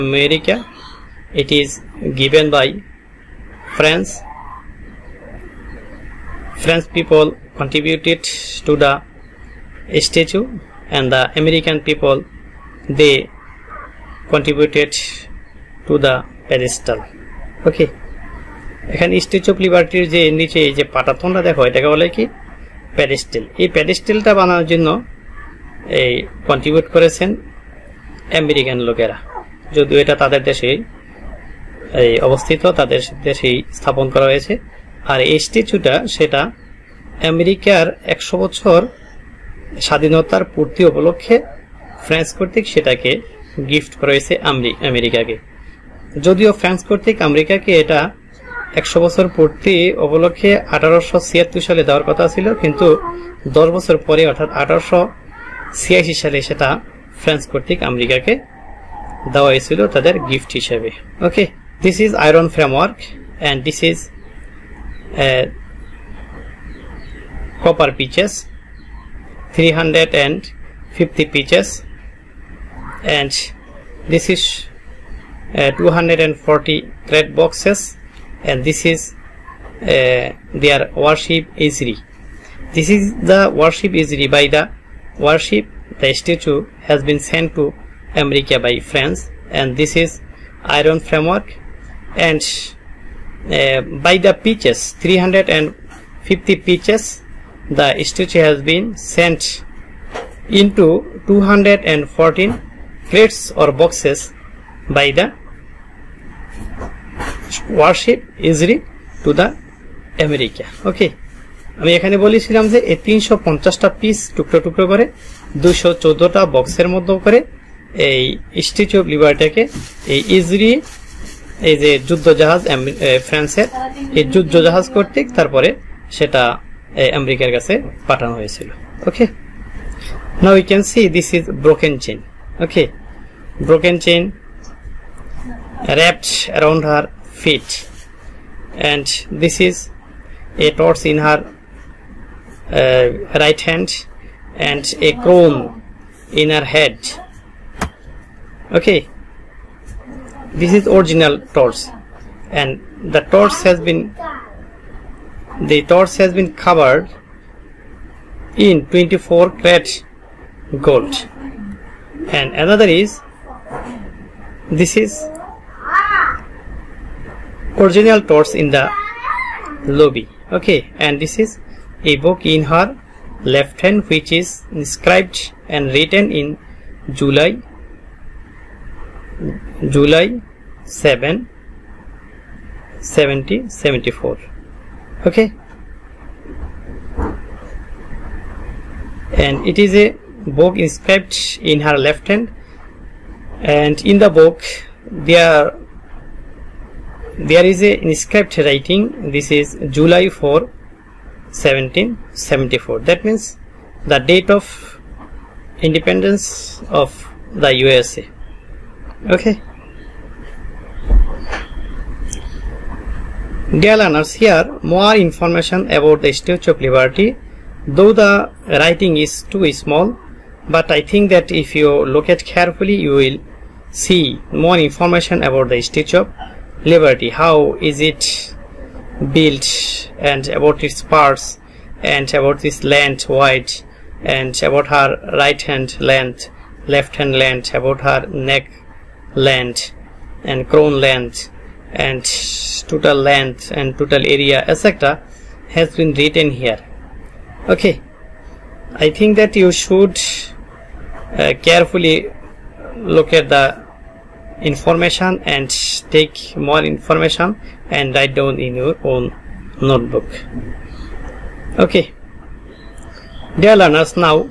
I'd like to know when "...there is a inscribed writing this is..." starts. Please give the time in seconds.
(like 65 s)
197 s.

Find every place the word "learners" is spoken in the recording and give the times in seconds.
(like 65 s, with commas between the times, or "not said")
213 s, 263 s.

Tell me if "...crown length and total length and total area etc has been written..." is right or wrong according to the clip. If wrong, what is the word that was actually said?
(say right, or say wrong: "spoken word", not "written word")
right.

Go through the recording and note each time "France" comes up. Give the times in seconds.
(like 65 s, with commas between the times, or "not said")
3 s, 88 s.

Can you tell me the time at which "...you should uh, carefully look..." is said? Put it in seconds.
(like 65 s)
249 s.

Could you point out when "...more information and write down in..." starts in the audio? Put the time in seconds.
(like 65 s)
256 s.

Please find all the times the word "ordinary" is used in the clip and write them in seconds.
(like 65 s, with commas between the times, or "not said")
not said.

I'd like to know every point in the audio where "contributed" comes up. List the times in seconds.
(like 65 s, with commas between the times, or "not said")
7 s, 14 s.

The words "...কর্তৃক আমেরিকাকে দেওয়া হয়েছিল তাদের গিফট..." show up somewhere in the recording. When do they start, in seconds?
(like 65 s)
57 s.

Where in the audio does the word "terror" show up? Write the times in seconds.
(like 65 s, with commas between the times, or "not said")
not said.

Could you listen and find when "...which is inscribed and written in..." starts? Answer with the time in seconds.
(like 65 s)
174 s.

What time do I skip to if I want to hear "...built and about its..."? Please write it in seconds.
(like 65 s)
229 s.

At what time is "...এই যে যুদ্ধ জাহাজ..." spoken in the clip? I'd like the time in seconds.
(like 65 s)
121 s.